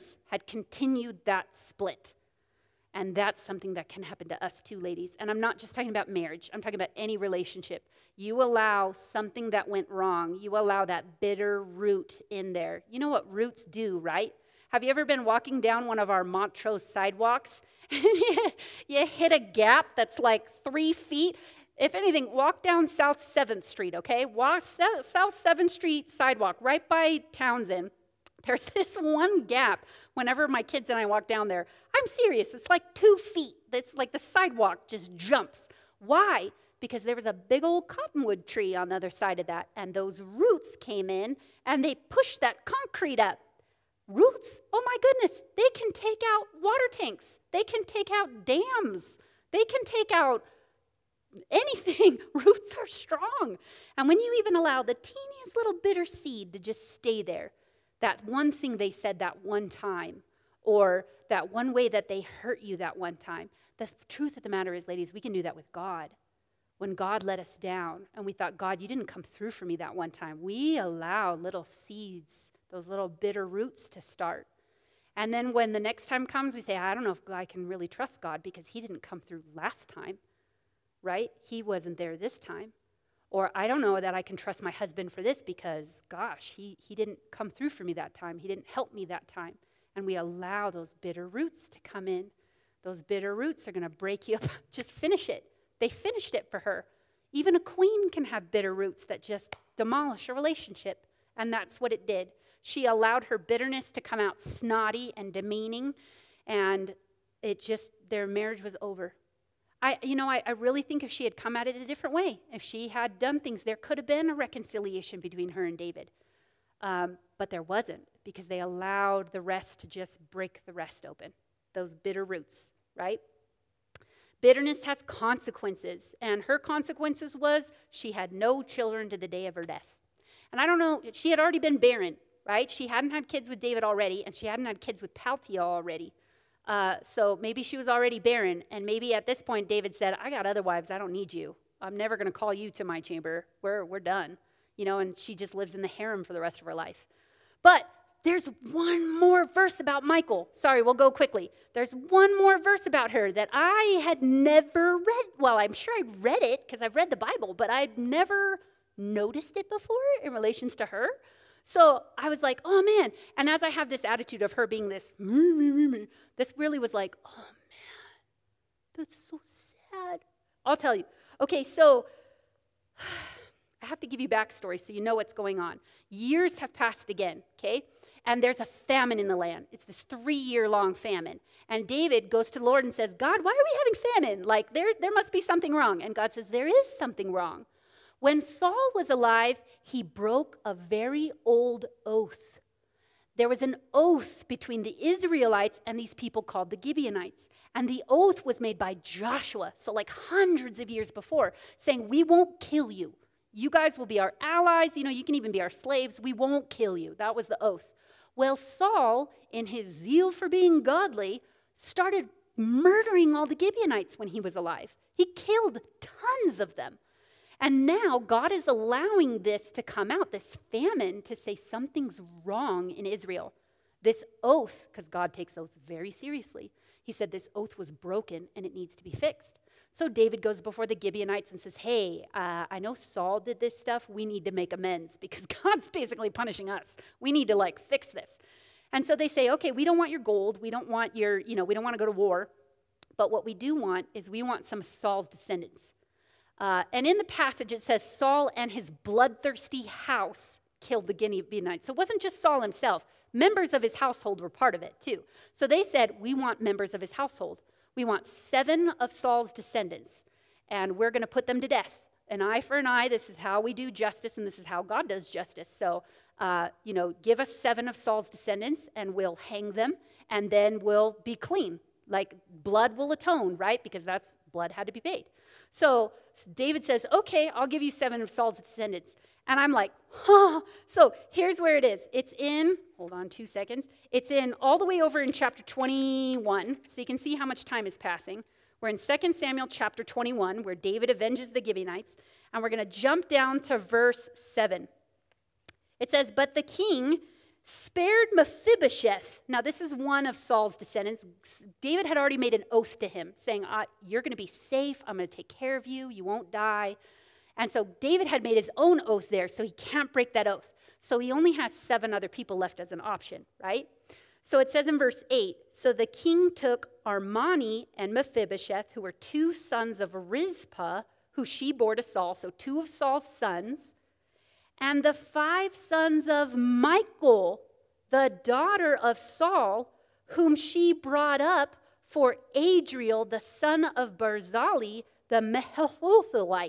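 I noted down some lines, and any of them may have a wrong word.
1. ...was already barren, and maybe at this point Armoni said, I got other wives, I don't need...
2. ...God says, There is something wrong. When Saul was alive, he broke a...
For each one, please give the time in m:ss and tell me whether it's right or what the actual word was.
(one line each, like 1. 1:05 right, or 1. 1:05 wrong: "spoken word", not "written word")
1. 2:17 wrong: "David", not "Armoni"
2. 3:06 right.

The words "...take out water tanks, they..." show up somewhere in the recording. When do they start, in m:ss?
0:45.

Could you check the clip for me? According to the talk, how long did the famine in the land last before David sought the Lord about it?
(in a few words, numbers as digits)
3 years.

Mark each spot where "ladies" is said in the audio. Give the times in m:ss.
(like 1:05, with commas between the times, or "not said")
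0:04, 1:04.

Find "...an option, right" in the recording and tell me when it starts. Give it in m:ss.
5:12.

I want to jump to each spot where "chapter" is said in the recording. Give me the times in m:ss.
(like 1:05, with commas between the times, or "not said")
4:45, 4:49.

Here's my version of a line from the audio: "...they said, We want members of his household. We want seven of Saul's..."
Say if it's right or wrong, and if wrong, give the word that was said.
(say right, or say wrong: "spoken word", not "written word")
right.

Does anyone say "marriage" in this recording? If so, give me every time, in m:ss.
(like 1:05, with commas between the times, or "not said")
0:06, 1:48.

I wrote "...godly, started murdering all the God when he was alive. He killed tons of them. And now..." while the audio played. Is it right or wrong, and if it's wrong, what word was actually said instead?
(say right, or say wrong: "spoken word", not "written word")
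wrong: "Gibeonites", not "God".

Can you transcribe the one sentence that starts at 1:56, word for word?
Um, but there wasn't because they allowed the rest to just break the rest open, those bitter roots, right?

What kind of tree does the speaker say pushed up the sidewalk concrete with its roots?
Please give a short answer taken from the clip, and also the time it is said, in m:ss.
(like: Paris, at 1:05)
cottonwood, at 0:37.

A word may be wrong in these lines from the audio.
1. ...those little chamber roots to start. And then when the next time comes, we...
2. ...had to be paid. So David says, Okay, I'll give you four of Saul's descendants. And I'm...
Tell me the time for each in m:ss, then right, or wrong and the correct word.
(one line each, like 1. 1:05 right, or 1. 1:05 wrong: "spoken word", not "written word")
1. 1:12 wrong: "bitter", not "chamber"
2. 4:34 wrong: "seven", not "four".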